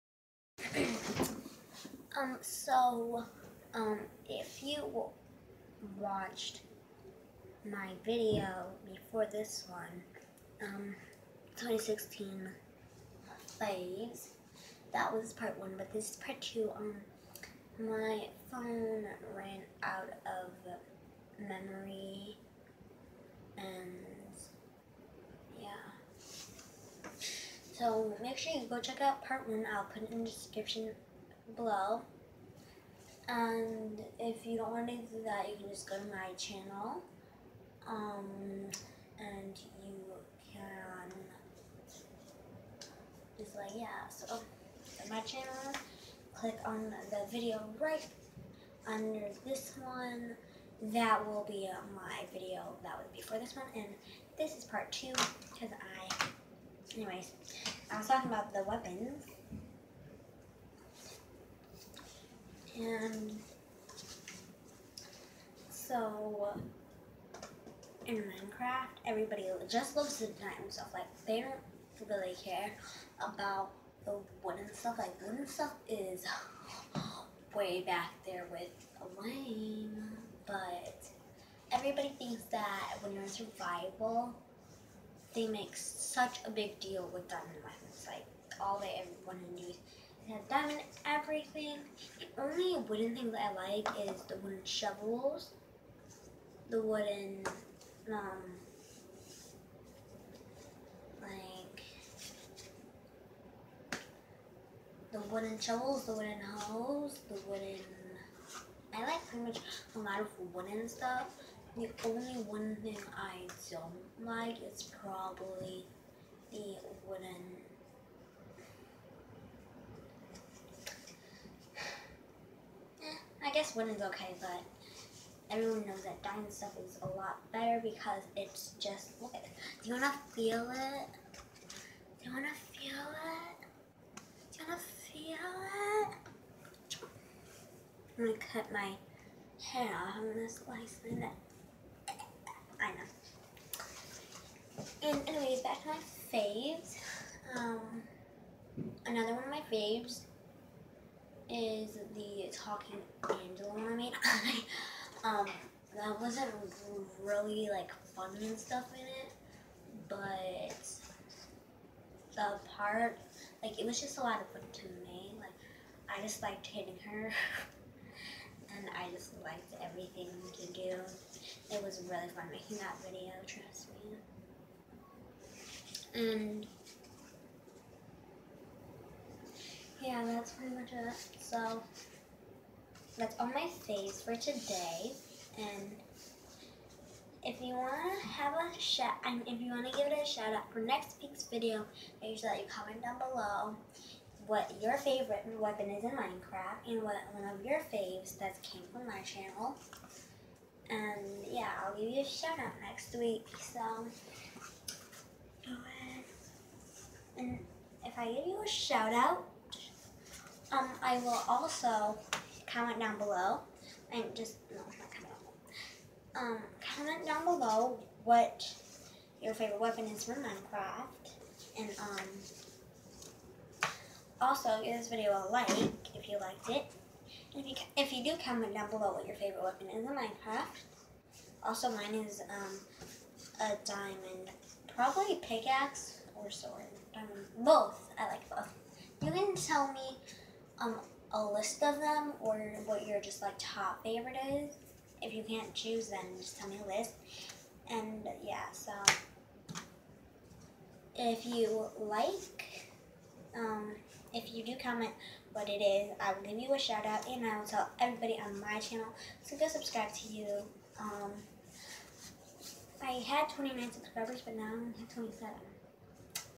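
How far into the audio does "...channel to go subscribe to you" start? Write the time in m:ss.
4:18.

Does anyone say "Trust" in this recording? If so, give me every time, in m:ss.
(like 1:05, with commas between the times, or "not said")
2:53.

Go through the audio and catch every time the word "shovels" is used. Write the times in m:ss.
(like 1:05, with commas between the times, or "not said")
1:34, 1:45.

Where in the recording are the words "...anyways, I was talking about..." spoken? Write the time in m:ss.
0:56.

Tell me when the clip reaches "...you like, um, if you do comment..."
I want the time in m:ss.
4:11.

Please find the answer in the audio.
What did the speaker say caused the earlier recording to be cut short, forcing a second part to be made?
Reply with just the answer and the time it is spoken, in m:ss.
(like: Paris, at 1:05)
Phone ran out of memory, at 0:17.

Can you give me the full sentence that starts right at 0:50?
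That will be uh, my video that was before this one.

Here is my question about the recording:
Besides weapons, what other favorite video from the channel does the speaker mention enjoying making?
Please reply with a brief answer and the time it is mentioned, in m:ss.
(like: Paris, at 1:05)
Talking Angela mermaid, at 2:32.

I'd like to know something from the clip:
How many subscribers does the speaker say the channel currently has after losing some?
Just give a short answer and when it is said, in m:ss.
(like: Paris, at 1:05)
27, at 4:25.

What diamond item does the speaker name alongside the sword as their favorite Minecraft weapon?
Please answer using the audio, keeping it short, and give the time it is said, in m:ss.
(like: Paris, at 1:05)
Pickaxe, at 3:55.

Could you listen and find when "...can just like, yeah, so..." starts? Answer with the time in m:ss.
0:40.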